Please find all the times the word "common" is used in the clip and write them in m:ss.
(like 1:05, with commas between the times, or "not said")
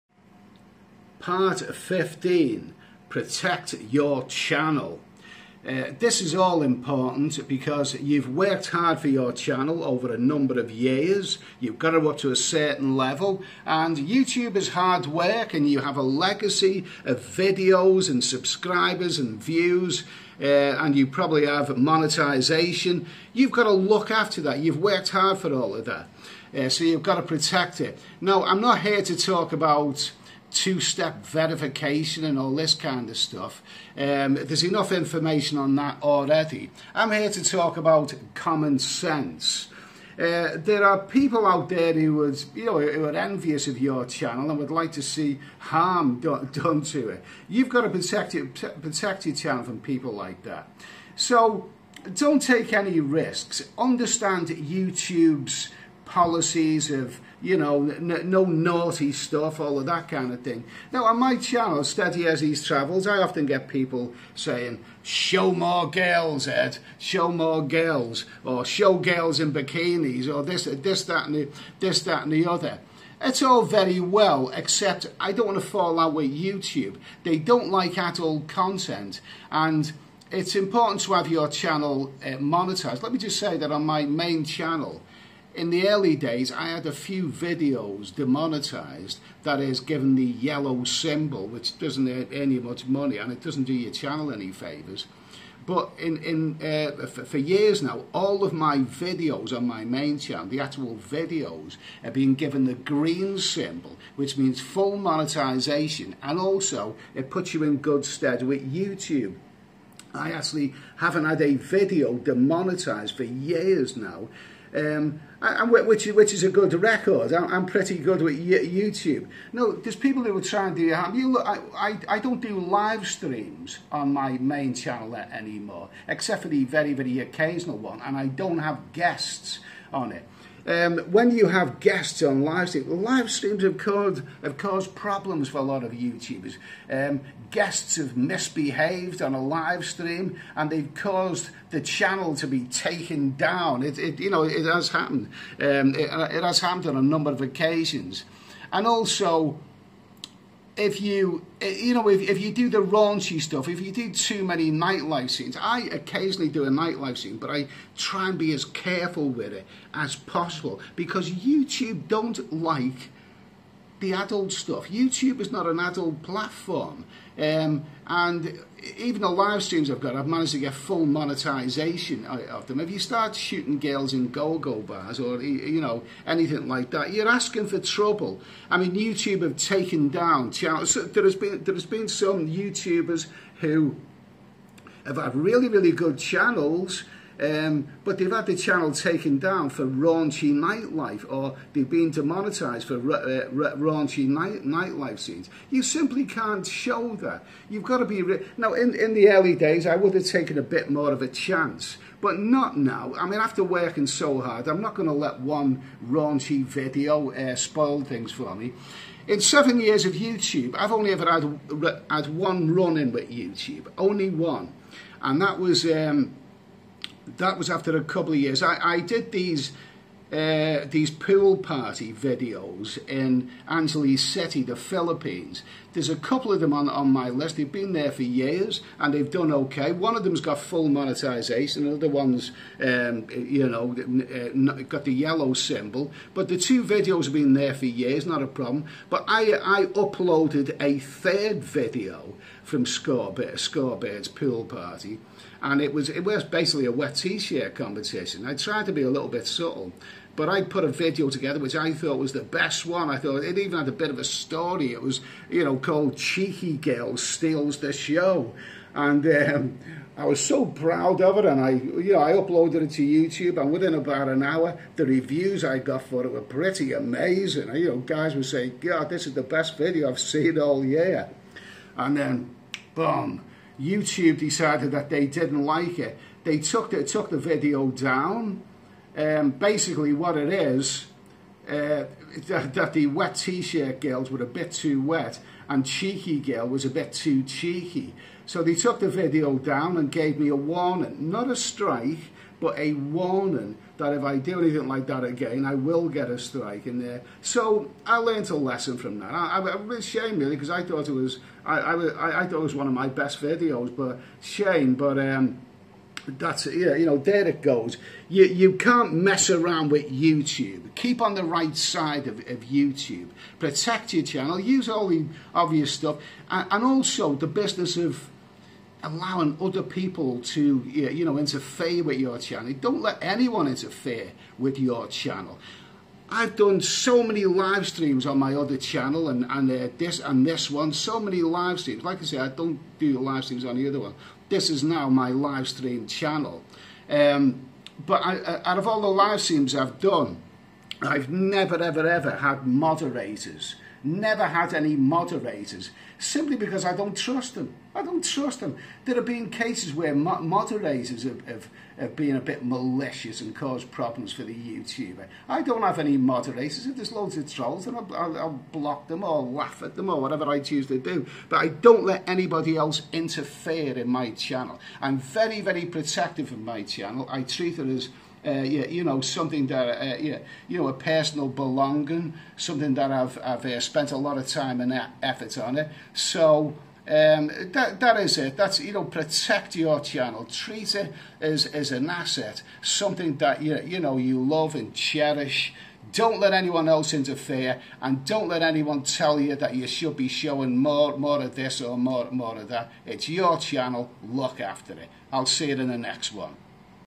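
0:38.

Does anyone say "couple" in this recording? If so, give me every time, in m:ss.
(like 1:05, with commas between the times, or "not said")
3:38, 3:46.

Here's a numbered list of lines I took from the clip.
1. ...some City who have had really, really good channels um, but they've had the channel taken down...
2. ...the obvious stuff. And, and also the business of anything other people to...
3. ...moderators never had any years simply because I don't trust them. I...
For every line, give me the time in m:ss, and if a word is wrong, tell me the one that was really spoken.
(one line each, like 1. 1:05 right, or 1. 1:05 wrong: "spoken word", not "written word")
1. 3:02 wrong: "YouTubers", not "City"
2. 5:15 wrong: "allowing", not "anything"
3. 5:42 wrong: "moderators", not "years".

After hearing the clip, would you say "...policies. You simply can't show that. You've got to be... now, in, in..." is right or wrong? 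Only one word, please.
wrong.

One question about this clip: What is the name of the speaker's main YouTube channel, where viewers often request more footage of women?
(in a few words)
Steady Eddy's Travels.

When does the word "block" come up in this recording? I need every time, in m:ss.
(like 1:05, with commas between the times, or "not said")
5:58.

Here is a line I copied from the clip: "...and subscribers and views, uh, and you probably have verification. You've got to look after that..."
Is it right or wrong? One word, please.
wrong.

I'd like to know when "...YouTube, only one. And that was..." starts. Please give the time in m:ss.
3:33.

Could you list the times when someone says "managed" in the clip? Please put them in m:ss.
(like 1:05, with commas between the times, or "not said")
2:50.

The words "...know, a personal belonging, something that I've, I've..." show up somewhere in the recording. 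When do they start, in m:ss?
6:10.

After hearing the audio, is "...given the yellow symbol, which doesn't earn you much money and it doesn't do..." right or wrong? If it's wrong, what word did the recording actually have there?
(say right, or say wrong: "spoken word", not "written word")
right.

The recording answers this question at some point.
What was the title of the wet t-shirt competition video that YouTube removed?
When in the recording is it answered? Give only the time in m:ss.
4:16.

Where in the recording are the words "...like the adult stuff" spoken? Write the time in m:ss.
2:42.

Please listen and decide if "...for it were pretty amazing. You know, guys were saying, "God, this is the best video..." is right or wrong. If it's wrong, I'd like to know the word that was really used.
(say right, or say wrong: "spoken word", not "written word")
right.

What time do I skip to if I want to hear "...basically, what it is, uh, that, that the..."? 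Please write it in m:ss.
4:39.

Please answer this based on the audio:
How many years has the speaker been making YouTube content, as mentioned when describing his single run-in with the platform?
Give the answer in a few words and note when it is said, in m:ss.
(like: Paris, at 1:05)
7, at 3:29.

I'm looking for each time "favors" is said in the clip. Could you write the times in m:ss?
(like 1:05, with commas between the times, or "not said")
1:34.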